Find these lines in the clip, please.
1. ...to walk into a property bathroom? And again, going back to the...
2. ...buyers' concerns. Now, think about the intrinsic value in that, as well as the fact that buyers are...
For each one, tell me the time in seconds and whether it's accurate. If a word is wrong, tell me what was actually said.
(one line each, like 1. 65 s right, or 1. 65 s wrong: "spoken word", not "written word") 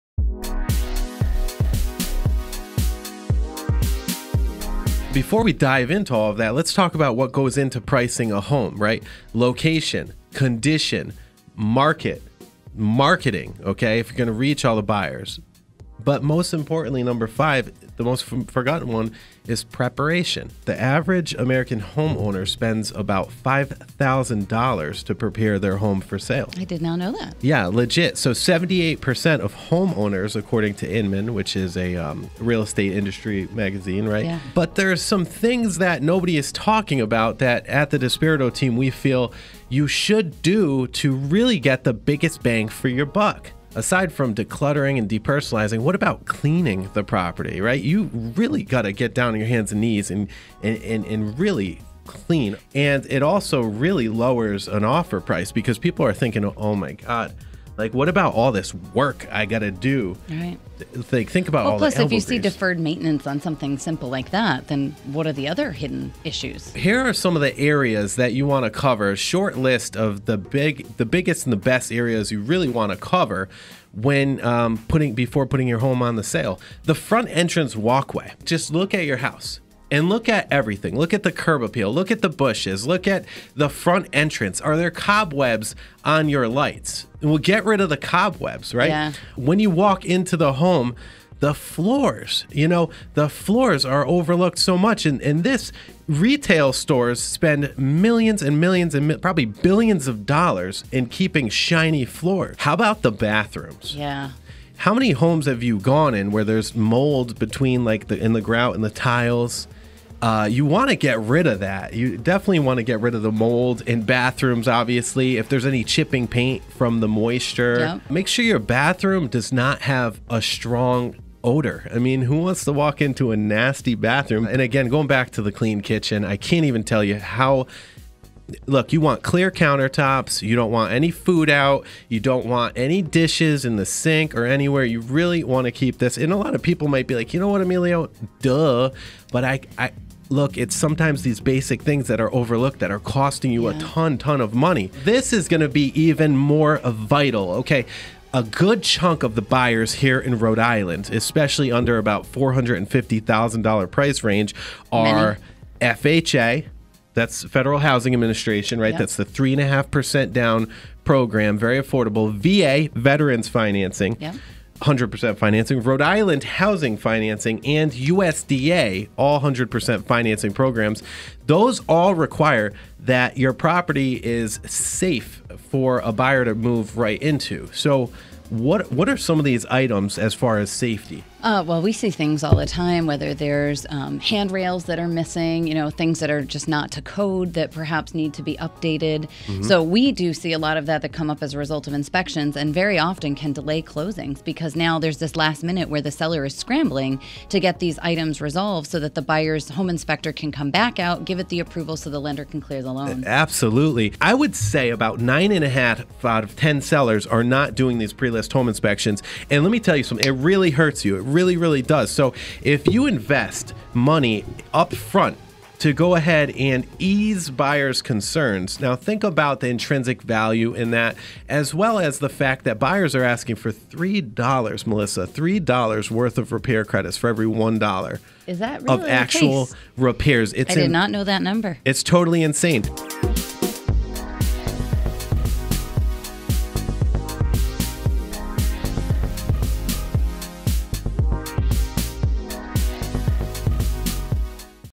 1. 122 s wrong: "nasty", not "property"
2. 217 s right.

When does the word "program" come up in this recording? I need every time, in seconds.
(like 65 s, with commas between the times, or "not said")
161 s, 170 s.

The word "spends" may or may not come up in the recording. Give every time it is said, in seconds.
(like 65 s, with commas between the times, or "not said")
22 s, 97 s.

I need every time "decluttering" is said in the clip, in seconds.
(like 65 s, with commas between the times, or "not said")
44 s.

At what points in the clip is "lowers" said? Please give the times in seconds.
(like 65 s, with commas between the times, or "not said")
54 s.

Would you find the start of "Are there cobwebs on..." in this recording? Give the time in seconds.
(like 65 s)
84 s.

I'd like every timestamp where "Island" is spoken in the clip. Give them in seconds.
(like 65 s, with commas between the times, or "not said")
150 s, 166 s.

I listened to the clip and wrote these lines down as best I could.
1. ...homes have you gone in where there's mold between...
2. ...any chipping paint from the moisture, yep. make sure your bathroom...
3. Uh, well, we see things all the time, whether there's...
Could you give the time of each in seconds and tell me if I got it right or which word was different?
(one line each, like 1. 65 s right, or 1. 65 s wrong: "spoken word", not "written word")
1. 105 s right
2. 115 s right
3. 181 s right.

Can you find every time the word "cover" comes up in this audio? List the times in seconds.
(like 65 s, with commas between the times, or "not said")
68 s, 72 s.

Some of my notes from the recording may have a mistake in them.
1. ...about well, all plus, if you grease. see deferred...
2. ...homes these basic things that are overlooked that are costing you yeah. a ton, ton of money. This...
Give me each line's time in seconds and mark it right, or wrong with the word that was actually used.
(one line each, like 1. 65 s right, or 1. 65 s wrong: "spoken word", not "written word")
1. 61 s right
2. 140 s wrong: "sometimes", not "homes".